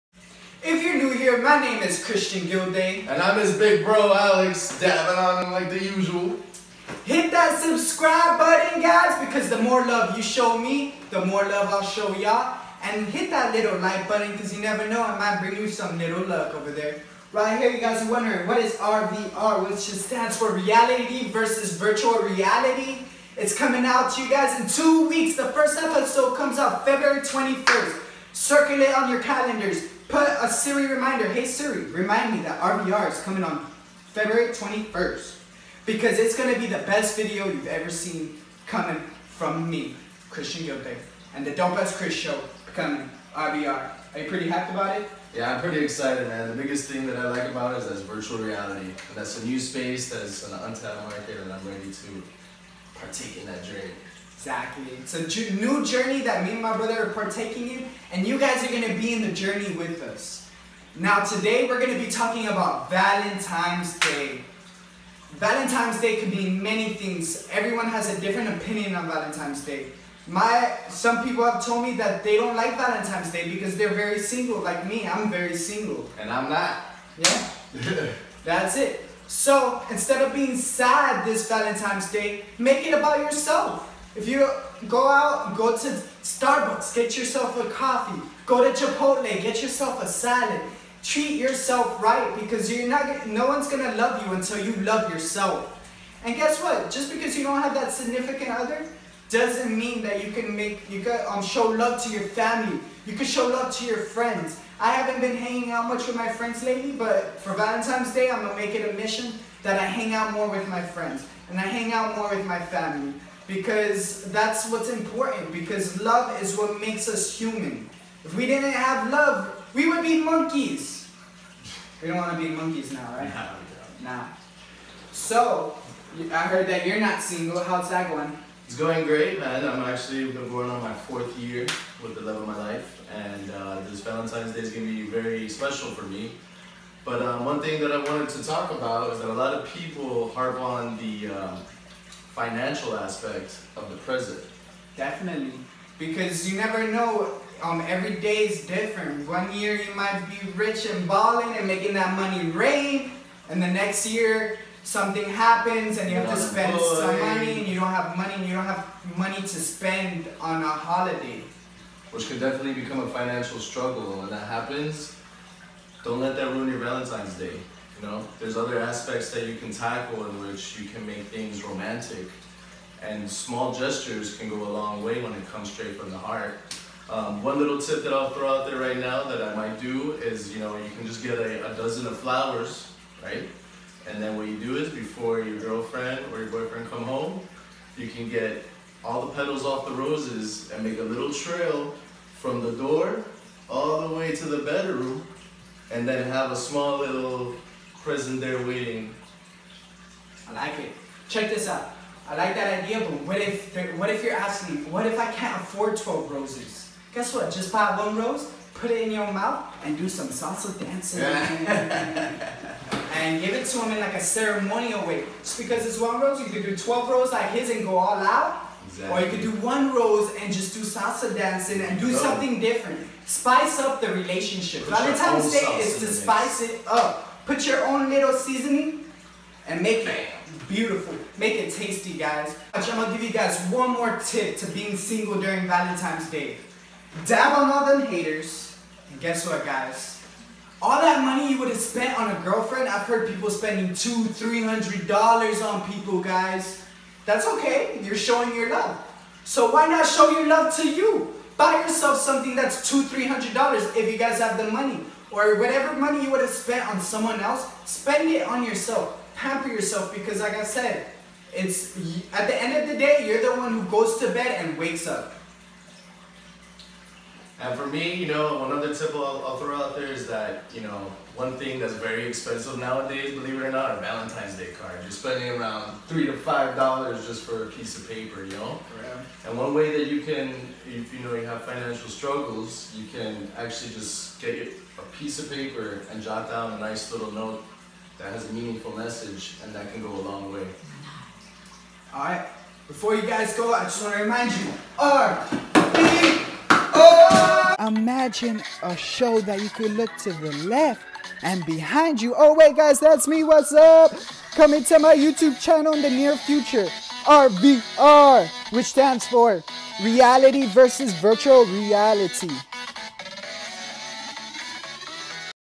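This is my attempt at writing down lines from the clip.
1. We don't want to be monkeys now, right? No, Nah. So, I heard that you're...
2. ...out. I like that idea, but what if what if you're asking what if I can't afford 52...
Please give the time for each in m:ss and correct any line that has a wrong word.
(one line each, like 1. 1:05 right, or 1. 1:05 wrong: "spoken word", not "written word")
1. 2:02 right
2. 3:21 wrong: "12", not "52".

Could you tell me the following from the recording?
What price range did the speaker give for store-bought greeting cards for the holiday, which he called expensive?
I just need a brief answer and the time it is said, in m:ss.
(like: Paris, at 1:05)
3 to 5 dollars, at 4:36.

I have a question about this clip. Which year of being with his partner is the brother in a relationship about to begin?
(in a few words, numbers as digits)
fourth year.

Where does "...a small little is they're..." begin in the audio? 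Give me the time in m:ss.
3:16.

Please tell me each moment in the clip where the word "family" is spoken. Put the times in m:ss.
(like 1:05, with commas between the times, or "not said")
1:42, 1:52.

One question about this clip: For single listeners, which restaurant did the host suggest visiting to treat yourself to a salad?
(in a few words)
Chipotle.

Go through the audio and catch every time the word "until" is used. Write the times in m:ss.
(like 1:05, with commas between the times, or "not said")
1:34.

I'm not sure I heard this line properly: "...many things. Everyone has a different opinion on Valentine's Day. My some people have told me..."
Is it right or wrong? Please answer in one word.
right.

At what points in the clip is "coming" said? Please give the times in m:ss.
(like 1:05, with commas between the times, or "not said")
0:23, 0:33, 0:38, 0:42, 5:04.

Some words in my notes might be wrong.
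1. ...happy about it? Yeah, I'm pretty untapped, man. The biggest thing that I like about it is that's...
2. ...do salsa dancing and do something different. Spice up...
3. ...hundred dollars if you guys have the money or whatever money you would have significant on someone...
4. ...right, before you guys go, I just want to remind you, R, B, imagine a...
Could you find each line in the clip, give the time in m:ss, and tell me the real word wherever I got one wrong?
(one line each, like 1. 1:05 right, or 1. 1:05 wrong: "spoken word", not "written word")
1. 0:44 wrong: "excited", not "untapped"
2. 3:40 right
3. 4:13 wrong: "spent", not "significant"
4. 4:52 right.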